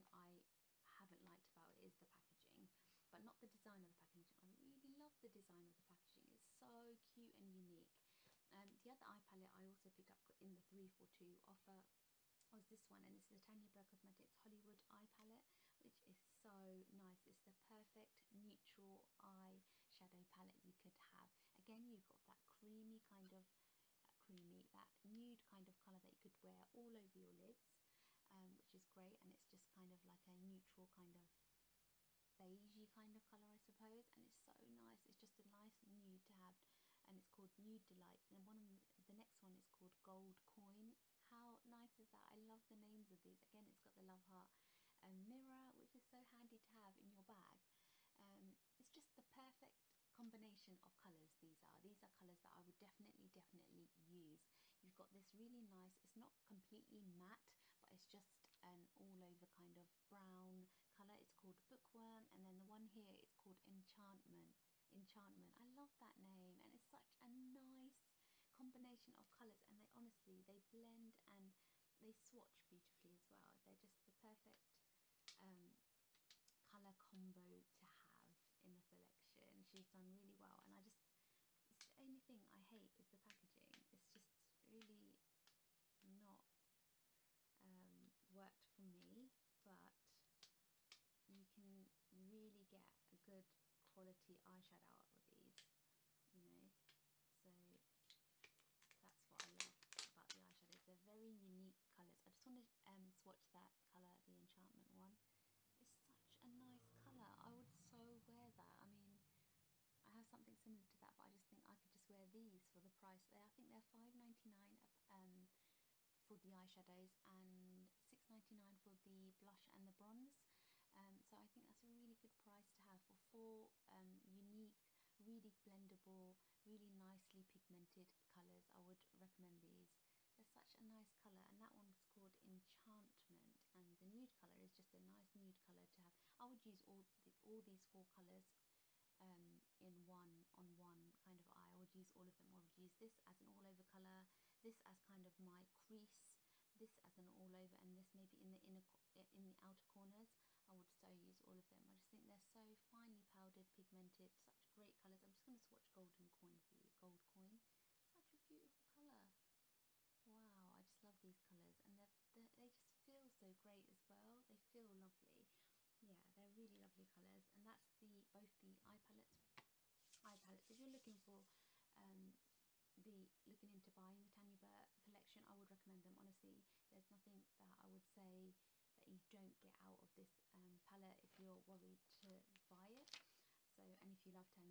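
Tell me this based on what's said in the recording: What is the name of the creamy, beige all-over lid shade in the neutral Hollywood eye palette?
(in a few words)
Nude Delight.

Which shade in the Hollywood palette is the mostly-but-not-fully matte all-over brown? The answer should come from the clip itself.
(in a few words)
Bookworm.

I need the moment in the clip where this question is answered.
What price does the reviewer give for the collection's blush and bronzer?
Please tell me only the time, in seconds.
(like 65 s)
118 s.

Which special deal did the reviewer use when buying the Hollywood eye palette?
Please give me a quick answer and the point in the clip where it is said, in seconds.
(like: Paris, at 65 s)
3 for 2 offer, at 10 s.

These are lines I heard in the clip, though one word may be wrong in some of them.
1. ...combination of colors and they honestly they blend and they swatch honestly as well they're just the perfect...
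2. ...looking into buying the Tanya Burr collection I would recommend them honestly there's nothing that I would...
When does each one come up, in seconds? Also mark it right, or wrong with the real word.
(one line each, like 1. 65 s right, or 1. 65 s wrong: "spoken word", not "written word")
1. 68 s wrong: "beautifully", not "honestly"
2. 173 s right.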